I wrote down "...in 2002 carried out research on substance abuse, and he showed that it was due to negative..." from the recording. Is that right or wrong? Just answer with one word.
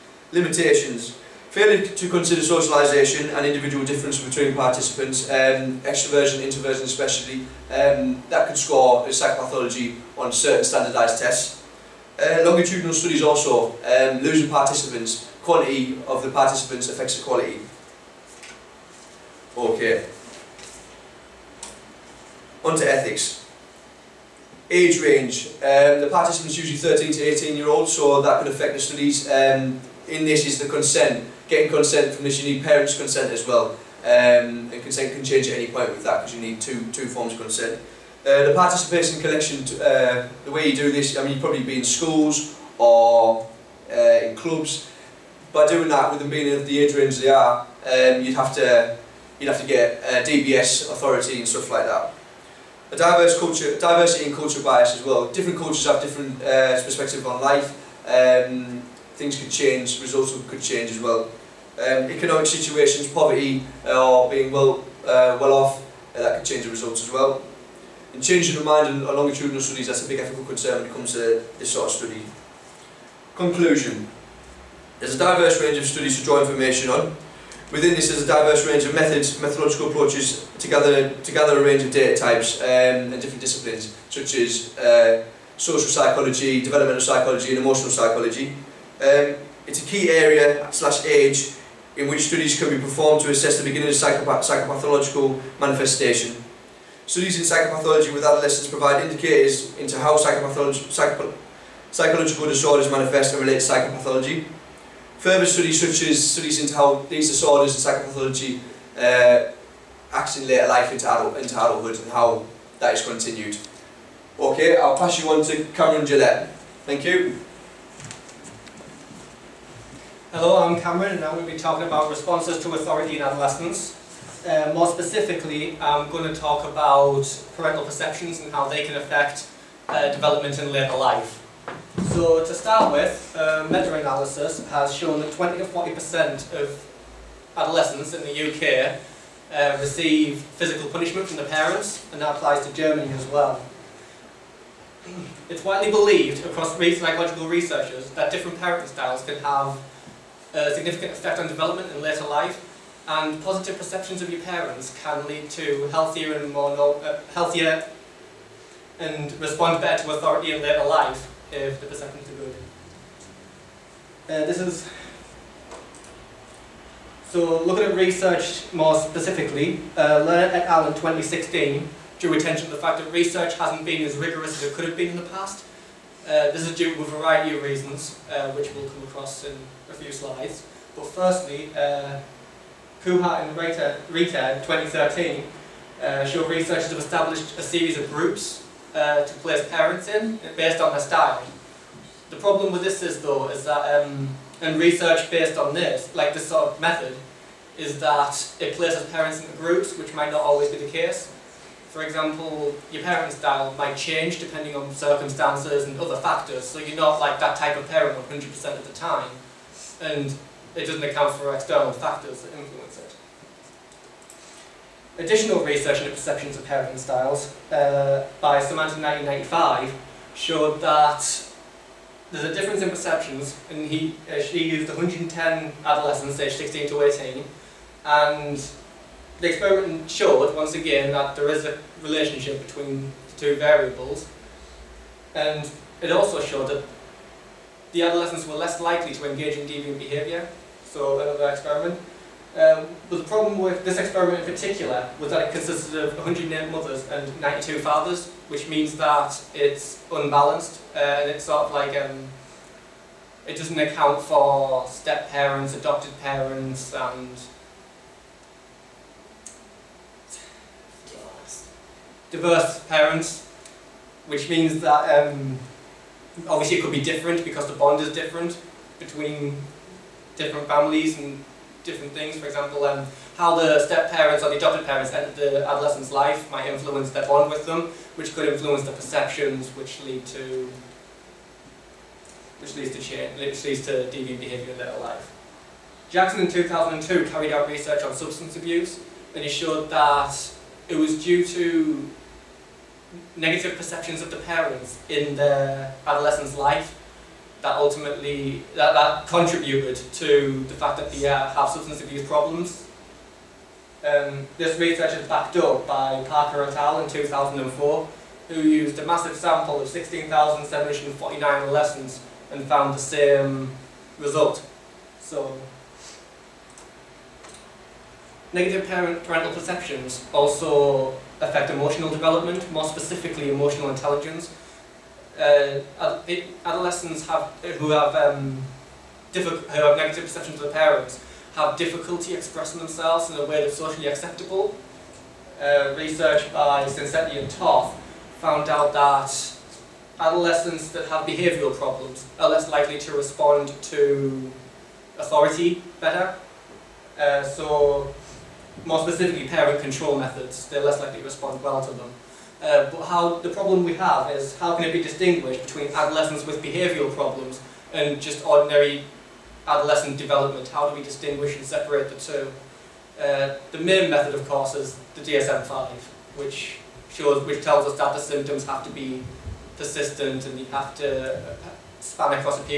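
right.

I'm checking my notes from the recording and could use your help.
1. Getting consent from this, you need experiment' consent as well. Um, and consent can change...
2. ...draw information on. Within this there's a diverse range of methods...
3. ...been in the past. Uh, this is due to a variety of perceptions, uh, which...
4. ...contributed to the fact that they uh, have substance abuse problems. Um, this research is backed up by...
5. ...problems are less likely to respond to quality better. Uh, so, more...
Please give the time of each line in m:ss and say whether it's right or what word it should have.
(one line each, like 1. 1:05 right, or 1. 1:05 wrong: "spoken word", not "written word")
1. 0:31 wrong: "parents", not "experiment"
2. 1:16 right
3. 2:54 wrong: "reasons", not "perceptions"
4. 4:59 right
5. 5:41 wrong: "authority", not "quality".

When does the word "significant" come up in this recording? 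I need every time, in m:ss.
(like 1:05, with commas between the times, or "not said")
2:30.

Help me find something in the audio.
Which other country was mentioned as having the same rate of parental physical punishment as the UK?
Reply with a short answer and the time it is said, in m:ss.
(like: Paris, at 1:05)
Germany, at 2:22.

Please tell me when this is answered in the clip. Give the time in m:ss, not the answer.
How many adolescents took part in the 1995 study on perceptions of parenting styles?
3:44.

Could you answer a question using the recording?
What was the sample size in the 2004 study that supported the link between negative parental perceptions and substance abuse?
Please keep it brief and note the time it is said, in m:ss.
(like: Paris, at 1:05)
16,749, at 5:09.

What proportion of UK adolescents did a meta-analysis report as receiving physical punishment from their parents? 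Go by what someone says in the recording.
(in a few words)
20 to 40%.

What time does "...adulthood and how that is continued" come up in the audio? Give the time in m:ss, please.
1:51.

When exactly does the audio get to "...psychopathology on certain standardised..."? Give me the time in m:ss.
0:09.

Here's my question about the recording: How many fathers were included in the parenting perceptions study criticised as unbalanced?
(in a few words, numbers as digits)
92.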